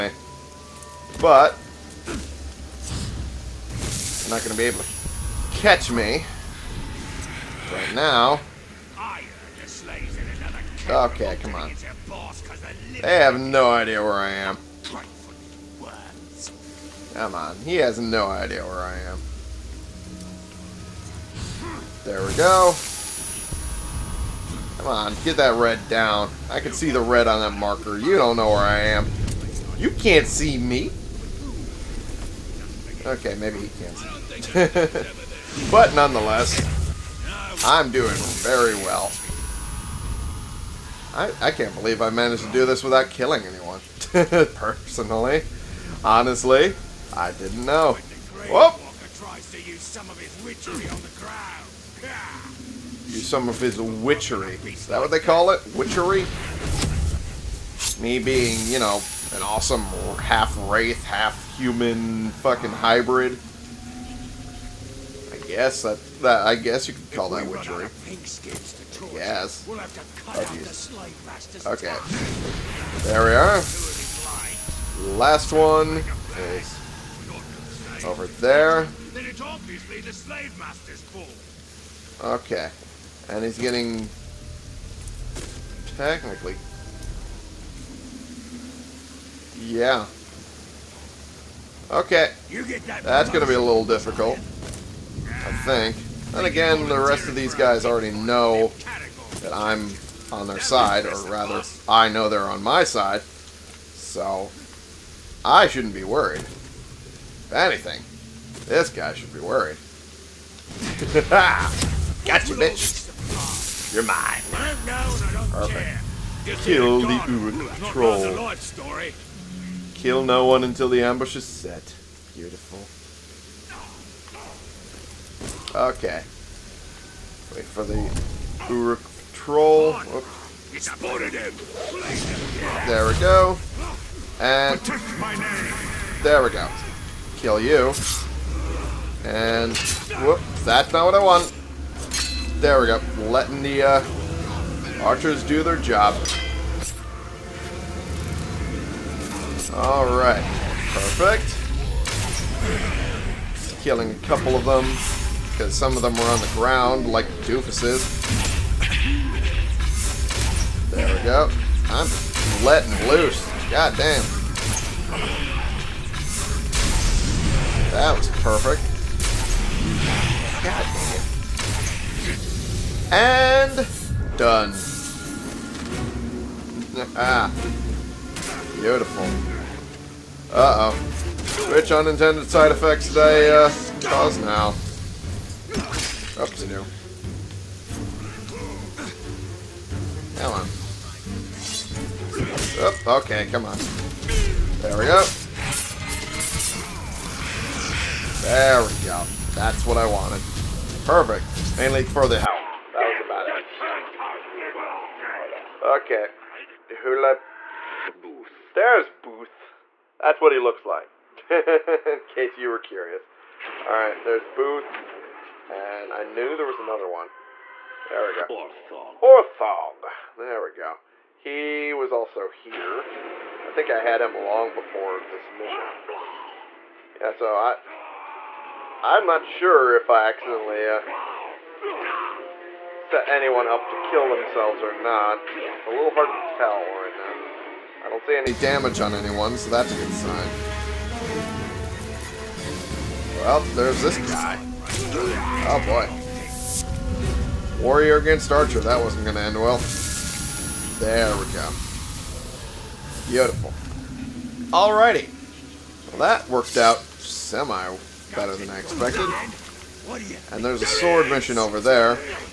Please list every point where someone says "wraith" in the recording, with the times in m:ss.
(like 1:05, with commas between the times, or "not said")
1:00.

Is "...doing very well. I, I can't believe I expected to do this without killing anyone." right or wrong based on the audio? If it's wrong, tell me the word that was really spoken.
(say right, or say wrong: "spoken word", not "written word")
wrong: "managed", not "expected".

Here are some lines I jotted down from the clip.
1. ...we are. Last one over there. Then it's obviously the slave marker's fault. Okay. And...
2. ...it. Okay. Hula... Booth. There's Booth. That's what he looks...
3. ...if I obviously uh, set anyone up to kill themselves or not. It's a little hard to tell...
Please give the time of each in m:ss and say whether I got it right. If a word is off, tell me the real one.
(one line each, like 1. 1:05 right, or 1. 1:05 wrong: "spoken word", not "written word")
1. 1:13 wrong: "master", not "marker"
2. 3:26 right
3. 3:49 wrong: "accidentally", not "obviously".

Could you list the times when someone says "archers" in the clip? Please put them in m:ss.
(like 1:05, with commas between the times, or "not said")
2:25, 4:08.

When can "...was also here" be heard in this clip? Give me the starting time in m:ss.
3:41.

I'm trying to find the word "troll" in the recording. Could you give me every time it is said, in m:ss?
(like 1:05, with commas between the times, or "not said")
1:57, 2:09.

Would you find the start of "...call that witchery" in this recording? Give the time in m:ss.
1:07.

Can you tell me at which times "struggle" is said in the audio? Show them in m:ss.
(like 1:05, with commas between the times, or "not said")
not said.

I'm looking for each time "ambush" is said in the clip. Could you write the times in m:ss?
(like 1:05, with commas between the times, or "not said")
2:01.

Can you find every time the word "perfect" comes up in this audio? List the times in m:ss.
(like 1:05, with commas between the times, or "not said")
1:55, 2:30, 2:48, 3:21.